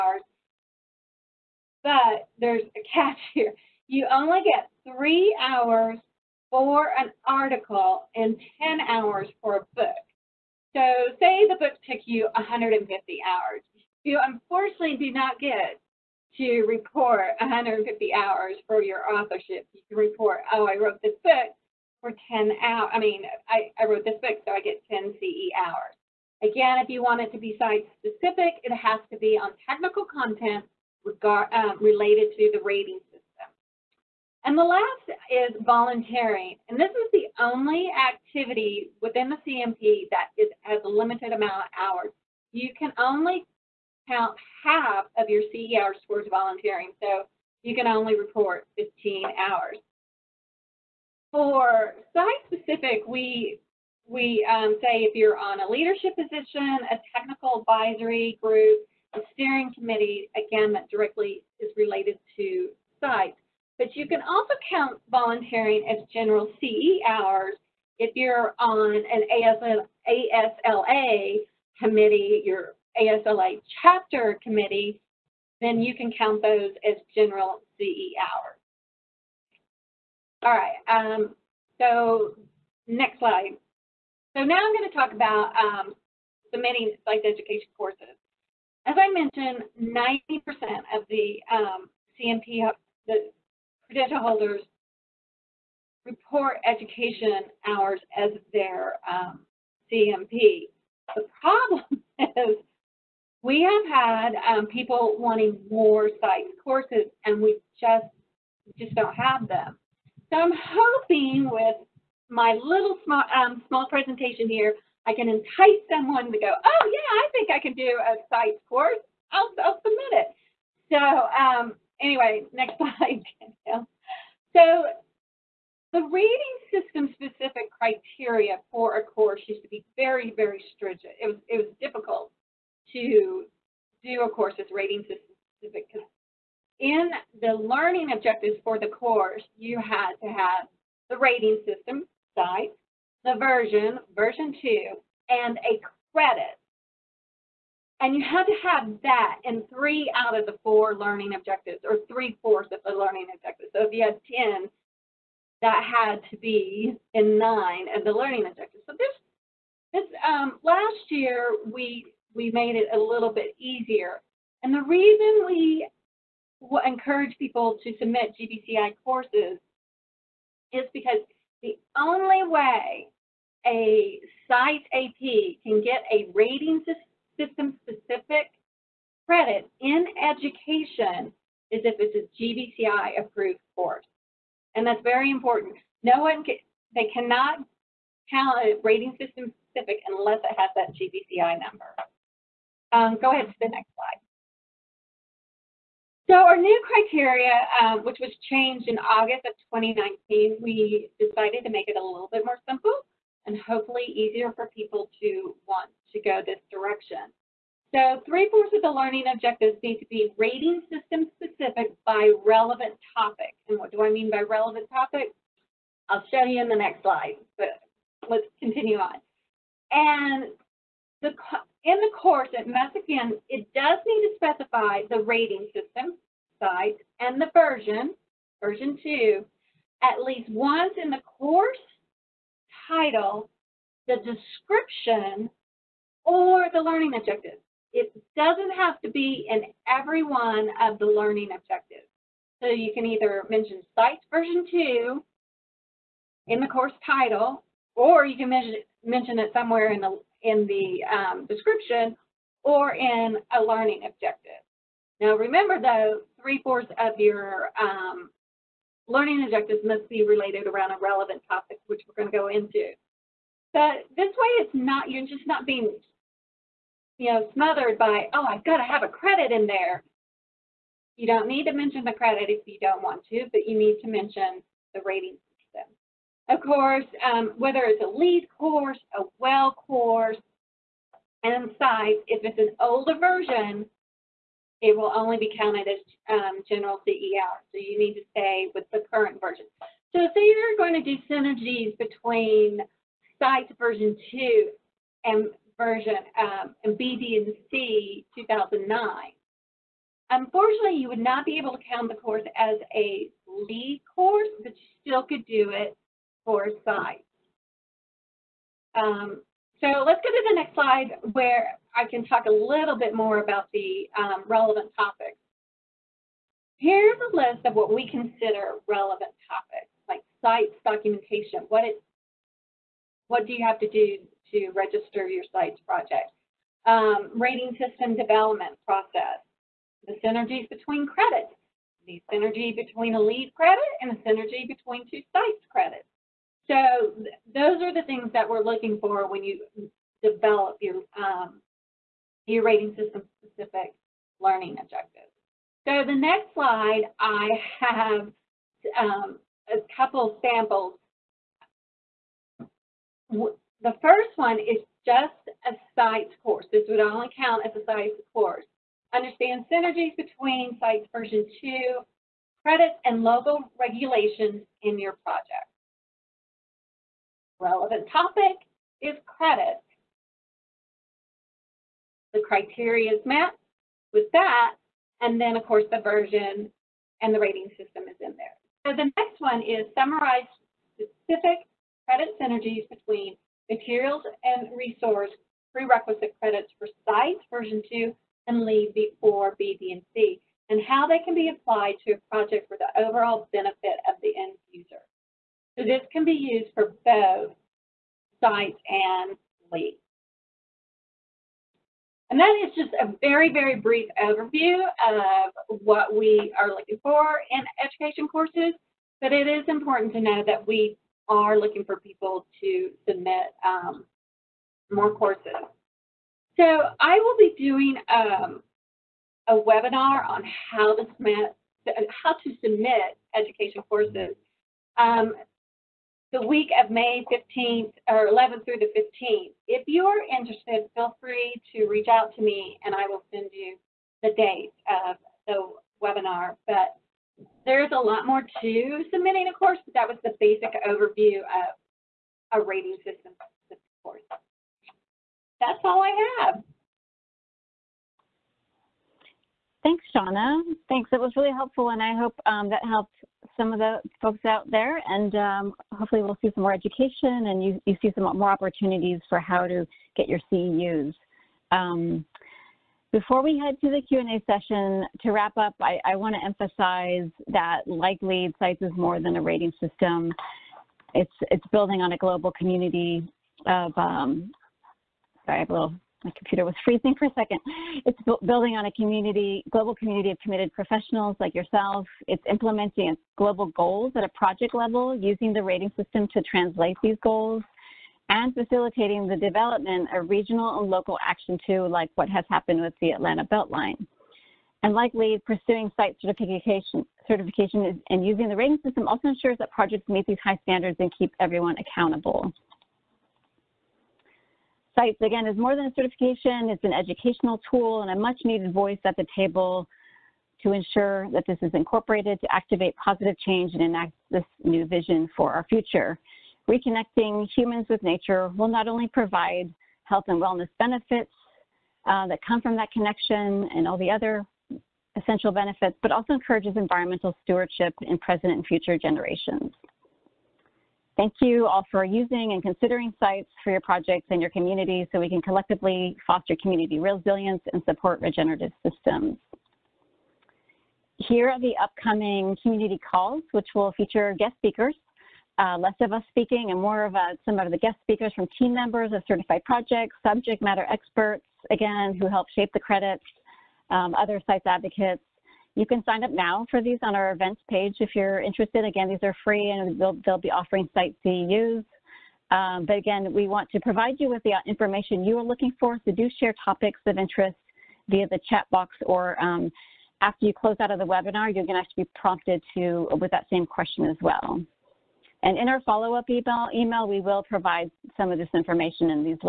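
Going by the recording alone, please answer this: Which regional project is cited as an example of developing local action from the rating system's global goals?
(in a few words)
Atlanta Beltline.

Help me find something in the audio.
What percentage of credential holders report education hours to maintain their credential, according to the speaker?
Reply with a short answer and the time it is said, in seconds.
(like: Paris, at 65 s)
90%, at 89 s.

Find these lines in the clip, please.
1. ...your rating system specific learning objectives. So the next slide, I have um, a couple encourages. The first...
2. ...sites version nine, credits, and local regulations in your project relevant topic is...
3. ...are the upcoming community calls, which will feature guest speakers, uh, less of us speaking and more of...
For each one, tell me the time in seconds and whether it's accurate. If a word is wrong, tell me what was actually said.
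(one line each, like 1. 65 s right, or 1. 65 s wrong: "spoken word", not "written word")
1. 342 s wrong: "samples", not "encourages"
2. 360 s wrong: "two", not "nine"
3. 541 s right.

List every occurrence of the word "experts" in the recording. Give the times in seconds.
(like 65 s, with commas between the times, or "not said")
550 s.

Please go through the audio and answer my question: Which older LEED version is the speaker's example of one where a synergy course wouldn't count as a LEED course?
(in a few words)
BD+C 2009.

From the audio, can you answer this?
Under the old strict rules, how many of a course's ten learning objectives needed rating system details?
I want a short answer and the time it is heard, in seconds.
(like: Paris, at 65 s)
9, at 157 s.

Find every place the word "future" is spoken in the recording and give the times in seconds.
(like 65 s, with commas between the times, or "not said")
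515 s, 528 s.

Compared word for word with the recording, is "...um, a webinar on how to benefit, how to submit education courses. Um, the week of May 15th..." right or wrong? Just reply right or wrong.
wrong.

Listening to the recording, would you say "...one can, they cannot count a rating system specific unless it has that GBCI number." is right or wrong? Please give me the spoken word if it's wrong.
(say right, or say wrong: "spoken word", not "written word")
right.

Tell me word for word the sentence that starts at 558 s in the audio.
Again, these are free and they'll, they'll be offering site CEUs.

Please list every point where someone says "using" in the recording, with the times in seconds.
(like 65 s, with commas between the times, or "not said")
485 s, 498 s, 532 s.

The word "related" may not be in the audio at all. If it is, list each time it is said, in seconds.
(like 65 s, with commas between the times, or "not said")
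31 s, 61 s, 260 s.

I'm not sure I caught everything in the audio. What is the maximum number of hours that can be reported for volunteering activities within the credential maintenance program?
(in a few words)
15.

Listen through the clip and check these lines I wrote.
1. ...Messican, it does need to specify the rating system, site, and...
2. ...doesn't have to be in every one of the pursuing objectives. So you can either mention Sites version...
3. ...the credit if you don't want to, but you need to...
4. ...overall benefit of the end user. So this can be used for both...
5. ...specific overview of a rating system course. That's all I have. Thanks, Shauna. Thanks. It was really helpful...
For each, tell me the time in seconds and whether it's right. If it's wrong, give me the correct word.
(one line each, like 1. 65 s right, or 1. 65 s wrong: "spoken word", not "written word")
1. 222 s right
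2. 238 s wrong: "learning", not "pursuing"
3. 272 s right
4. 393 s right
5. 440 s wrong: "basic", not "specific".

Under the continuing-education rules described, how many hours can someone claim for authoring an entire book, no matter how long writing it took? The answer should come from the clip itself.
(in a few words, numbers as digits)
10.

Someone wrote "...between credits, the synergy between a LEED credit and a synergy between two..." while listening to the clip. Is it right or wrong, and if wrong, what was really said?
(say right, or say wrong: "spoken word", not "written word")
right.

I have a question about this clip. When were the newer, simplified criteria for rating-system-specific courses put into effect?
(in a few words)
August 2019.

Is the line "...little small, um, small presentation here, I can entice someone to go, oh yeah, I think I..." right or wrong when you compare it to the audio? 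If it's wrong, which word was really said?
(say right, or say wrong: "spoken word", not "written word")
right.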